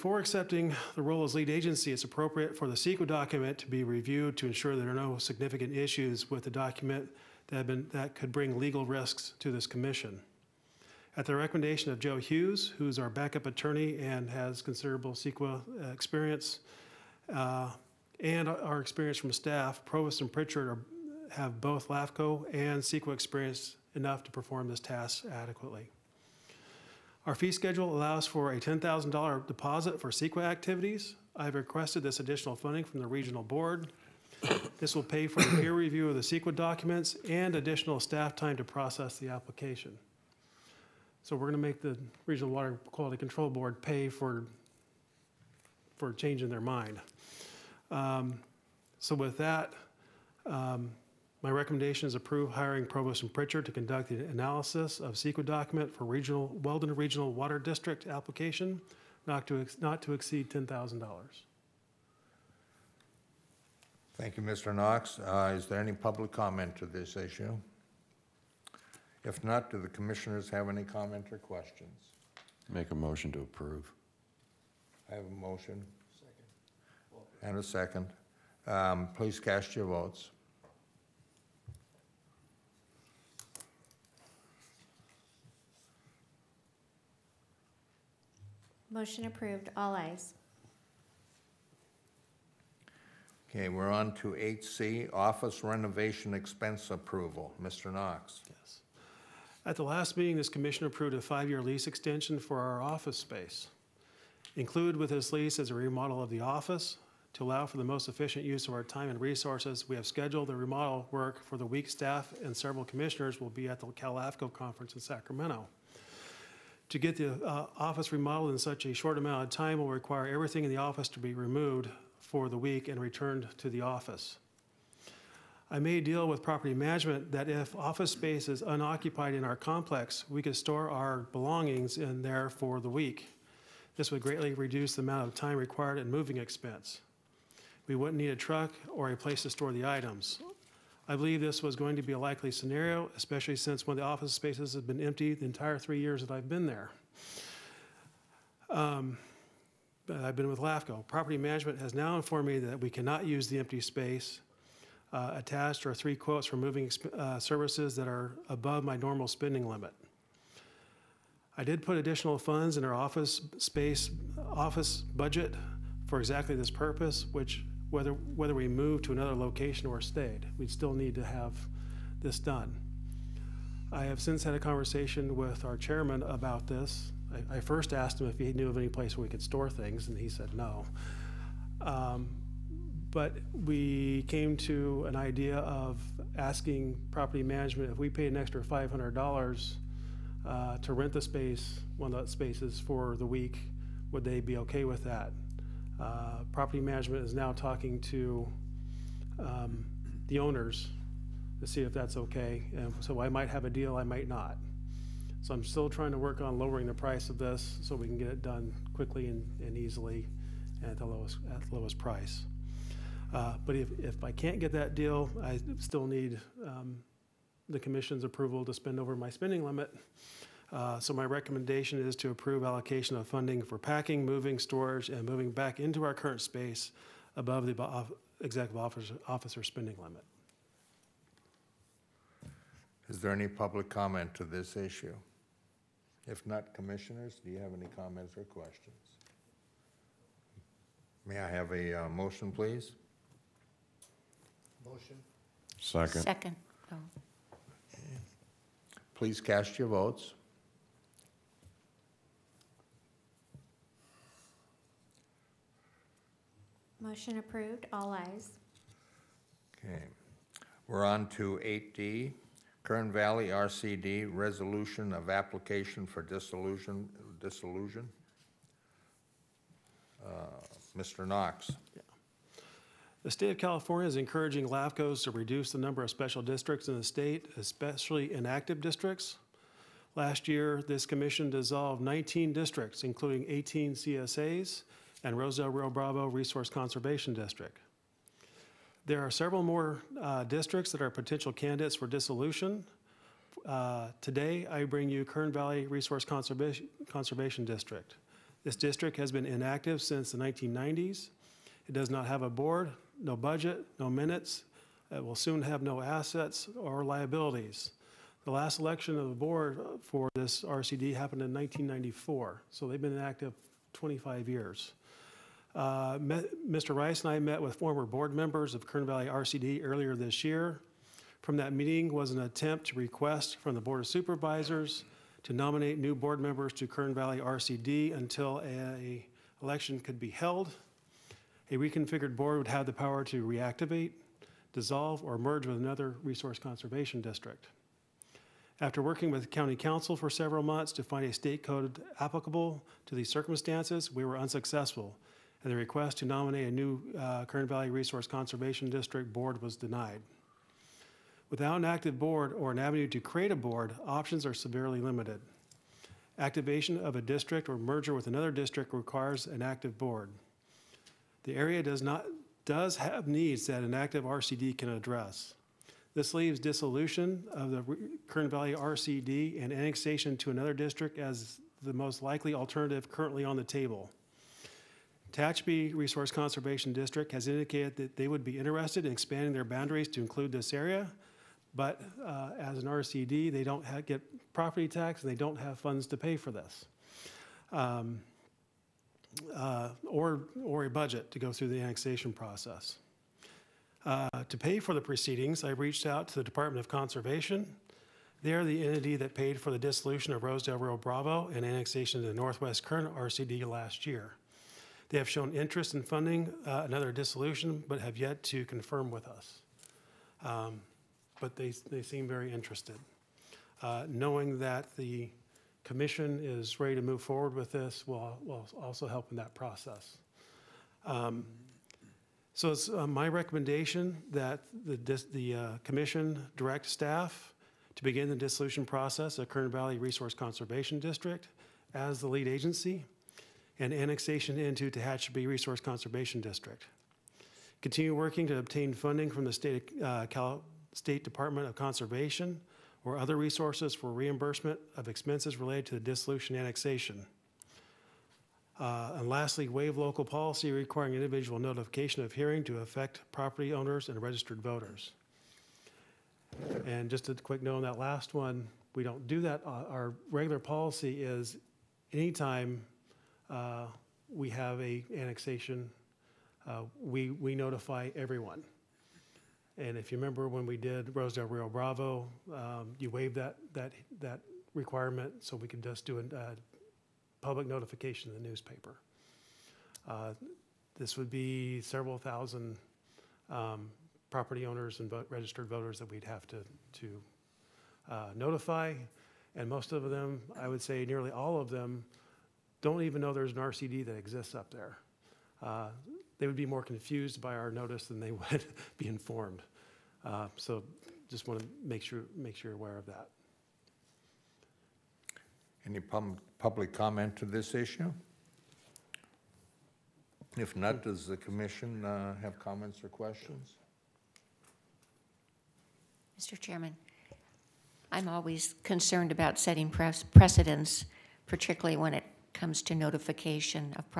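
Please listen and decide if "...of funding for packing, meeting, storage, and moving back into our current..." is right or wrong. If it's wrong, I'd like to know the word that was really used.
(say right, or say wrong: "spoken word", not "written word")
wrong: "moving", not "meeting".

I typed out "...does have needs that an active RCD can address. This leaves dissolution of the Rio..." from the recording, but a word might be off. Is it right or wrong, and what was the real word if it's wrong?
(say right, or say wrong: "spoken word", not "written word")
wrong: "Kern", not "Rio".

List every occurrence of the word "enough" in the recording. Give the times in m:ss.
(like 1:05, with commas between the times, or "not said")
0:23.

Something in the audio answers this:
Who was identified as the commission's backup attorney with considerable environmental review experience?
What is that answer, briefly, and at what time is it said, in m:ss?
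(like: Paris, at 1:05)
Joe Hughes, at 0:11.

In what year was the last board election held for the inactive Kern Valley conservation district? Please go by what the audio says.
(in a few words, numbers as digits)
1994.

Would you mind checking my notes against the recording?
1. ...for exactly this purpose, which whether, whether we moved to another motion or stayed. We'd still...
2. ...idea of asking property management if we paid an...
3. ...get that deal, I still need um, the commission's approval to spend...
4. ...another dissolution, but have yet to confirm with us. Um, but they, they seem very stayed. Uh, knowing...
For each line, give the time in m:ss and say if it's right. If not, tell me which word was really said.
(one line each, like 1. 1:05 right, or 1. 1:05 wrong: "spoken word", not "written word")
1. 2:46 wrong: "location", not "motion"
2. 3:05 right
3. 3:34 right
4. 6:46 wrong: "interested", not "stayed".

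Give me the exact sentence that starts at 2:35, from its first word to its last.
Uh, attached are three quotes for moving uh, services that are above my normal spending limit.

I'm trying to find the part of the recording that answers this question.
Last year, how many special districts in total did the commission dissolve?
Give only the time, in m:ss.
4:42.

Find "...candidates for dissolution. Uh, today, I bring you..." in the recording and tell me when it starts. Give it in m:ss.
4:51.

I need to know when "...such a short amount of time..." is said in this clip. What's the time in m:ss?
1:58.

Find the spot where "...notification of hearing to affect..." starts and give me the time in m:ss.
7:31.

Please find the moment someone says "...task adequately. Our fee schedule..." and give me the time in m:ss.
0:24.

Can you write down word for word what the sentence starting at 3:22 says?
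And so I might have a deal, I might not.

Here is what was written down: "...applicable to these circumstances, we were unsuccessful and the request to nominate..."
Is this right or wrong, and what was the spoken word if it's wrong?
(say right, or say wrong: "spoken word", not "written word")
right.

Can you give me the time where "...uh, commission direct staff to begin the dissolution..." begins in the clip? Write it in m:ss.
7:05.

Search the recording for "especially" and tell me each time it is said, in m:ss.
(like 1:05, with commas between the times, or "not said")
2:23, 4:37.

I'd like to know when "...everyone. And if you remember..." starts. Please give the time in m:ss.
7:48.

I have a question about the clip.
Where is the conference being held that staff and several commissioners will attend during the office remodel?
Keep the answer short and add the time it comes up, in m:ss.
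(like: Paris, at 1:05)
Sacramento, at 1:55.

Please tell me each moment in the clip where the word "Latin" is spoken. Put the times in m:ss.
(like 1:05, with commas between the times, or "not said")
not said.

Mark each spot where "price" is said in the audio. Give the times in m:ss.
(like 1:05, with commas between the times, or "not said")
3:26, 3:31.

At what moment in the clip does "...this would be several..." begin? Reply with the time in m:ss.
8:00.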